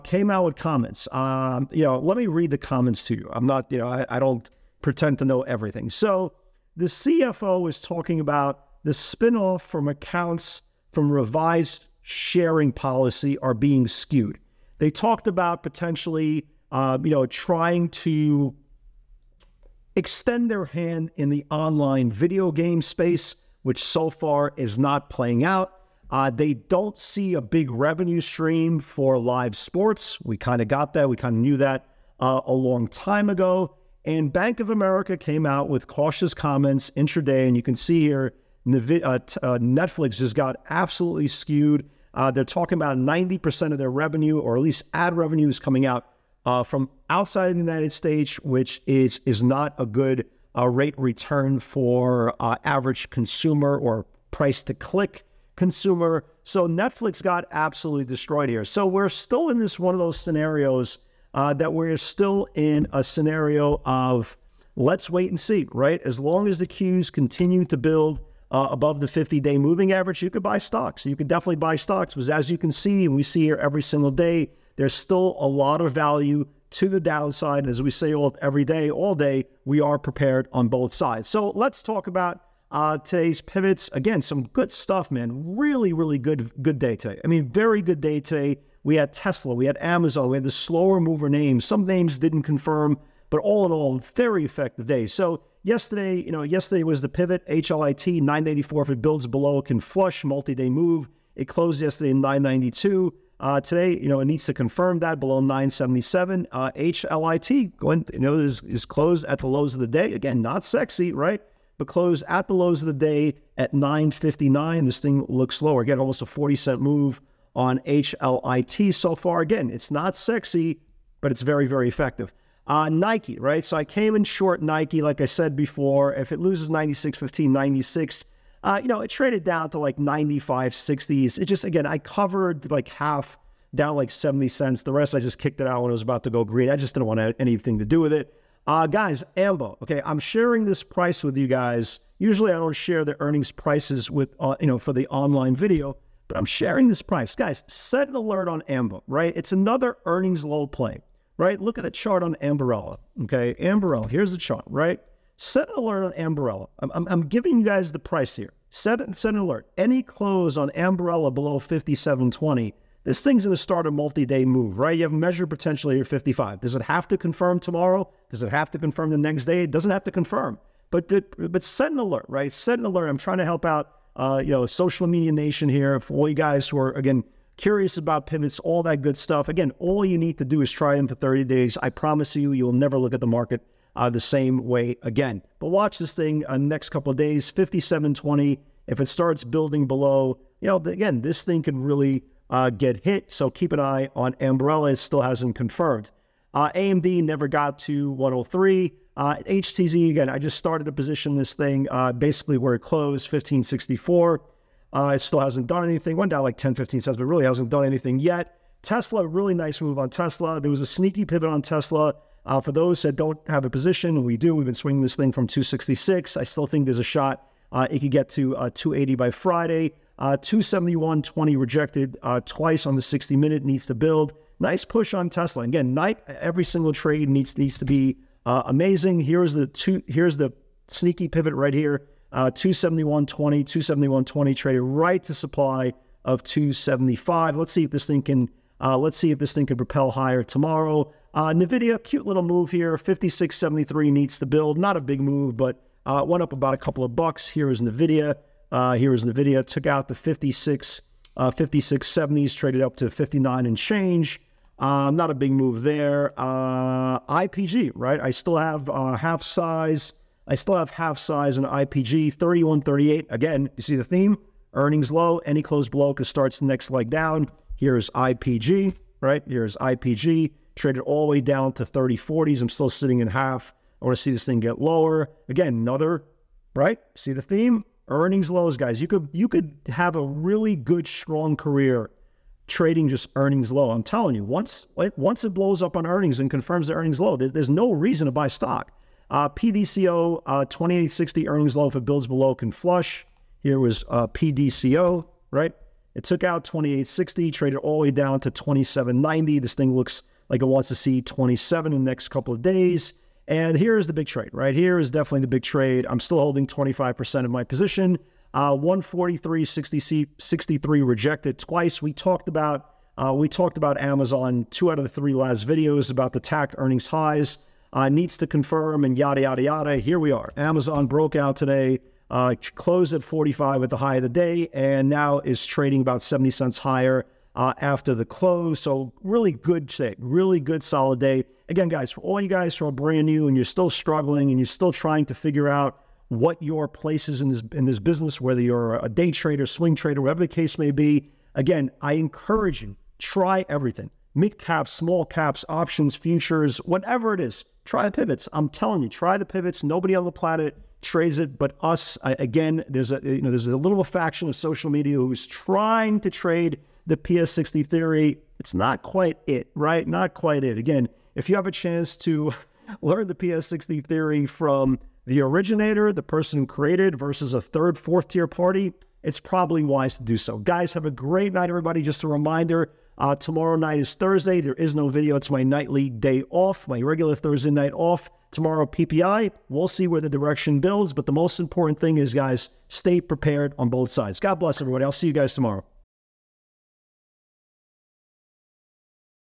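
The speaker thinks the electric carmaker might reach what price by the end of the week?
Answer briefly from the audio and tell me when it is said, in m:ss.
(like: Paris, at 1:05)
280, at 3:38.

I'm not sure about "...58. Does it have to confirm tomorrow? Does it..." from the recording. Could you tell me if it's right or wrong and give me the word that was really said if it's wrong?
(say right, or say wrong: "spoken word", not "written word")
wrong: "55", not "58".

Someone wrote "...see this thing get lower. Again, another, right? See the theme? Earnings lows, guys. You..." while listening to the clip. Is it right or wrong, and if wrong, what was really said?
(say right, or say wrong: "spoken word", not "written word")
right.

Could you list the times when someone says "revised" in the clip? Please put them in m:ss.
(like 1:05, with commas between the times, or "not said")
0:11.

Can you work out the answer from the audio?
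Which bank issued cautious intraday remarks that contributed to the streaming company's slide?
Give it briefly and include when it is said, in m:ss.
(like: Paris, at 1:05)
Bank of America, at 0:34.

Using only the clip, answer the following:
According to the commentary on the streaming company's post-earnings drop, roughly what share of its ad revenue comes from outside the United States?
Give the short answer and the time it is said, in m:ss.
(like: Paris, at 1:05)
90%, at 0:42.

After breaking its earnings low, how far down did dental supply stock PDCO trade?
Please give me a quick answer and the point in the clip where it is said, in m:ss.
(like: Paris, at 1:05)
27.90, at 4:58.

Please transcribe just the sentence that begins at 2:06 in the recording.
If it loses 96, 15, 96, uh, you know, it traded down to like 95, 60s.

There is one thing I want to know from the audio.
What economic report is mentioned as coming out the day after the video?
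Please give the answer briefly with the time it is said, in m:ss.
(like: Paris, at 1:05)
PPI, at 6:18.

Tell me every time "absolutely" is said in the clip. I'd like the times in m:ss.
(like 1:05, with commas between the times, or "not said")
0:40, 0:57.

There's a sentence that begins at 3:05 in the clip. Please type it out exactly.
But watch this thing uh, next couple of days, 5720.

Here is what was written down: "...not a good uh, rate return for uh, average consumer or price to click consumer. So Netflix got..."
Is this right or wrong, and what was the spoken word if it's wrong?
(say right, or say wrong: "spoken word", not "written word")
right.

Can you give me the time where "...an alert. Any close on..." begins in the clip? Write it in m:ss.
2:39.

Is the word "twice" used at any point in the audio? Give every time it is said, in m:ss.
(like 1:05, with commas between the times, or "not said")
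3:42, 5:11.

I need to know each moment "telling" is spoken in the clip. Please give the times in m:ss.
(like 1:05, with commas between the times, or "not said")
4:44, 5:48.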